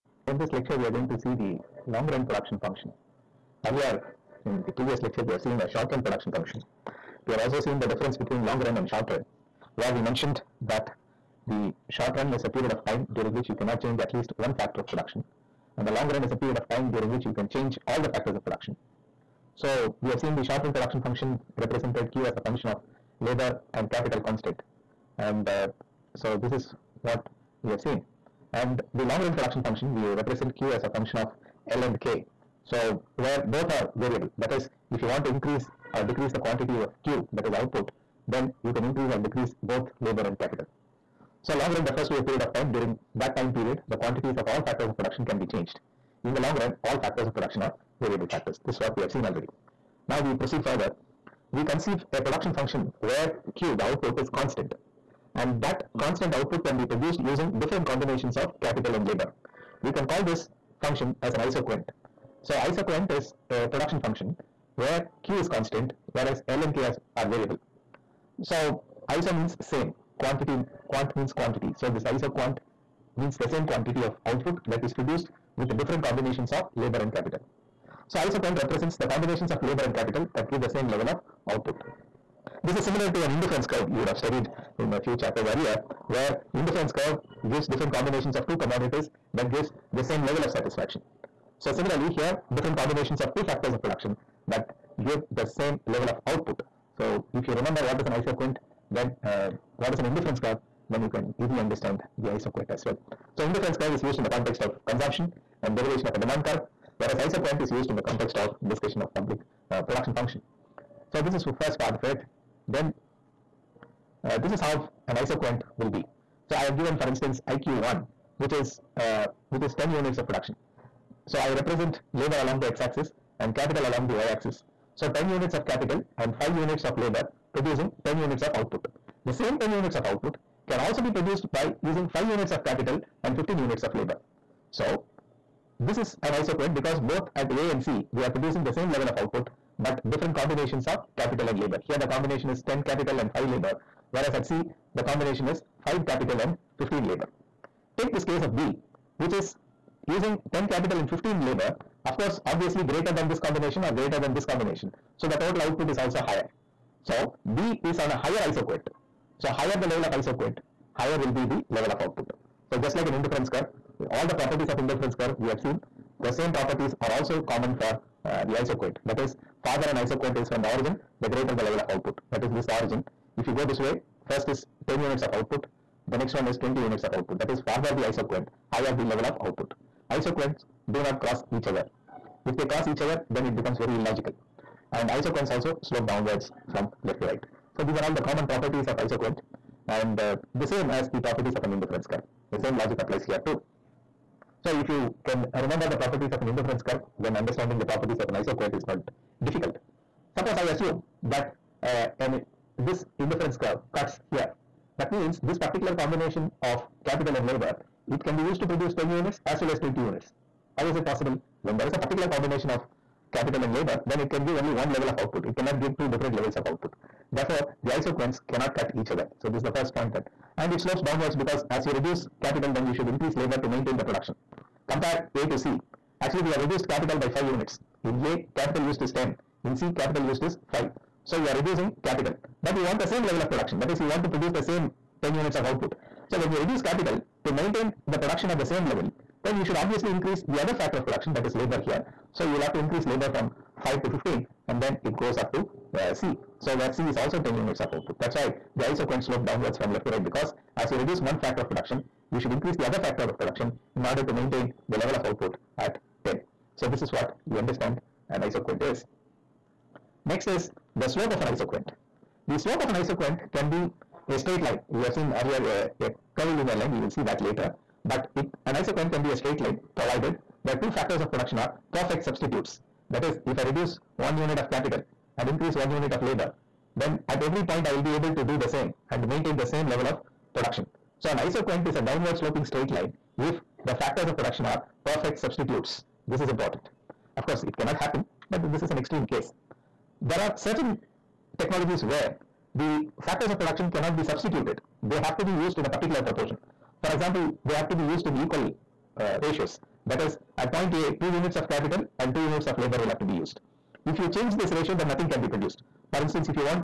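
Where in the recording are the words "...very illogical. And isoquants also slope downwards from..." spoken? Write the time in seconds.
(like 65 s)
183 s.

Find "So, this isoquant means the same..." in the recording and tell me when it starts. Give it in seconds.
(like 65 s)
71 s.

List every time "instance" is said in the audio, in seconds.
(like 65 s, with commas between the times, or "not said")
117 s, 306 s.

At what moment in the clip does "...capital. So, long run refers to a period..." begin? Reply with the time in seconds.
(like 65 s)
40 s.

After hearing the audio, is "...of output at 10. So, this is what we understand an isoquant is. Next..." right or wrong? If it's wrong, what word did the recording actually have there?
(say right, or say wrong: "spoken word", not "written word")
right.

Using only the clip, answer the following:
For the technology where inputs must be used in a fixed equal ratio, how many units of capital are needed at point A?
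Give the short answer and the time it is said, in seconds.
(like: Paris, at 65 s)
2, at 301 s.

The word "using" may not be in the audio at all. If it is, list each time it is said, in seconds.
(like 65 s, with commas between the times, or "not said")
57 s, 131 s, 150 s.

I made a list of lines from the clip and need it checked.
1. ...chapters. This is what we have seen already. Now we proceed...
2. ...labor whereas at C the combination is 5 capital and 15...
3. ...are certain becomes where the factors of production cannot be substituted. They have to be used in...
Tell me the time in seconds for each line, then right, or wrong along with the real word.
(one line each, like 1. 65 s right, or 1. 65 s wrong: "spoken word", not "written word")
1. 48 s wrong: "factors", not "chapters"
2. 143 s right
3. 290 s wrong: "technologies", not "becomes".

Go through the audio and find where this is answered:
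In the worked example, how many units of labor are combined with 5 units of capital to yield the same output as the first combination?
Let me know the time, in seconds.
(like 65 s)
133 s.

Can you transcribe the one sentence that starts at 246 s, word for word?
So, where C is also 10 units of output.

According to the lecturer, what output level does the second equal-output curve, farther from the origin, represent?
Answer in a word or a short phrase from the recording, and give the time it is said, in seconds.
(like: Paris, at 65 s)
20 units, at 176 s.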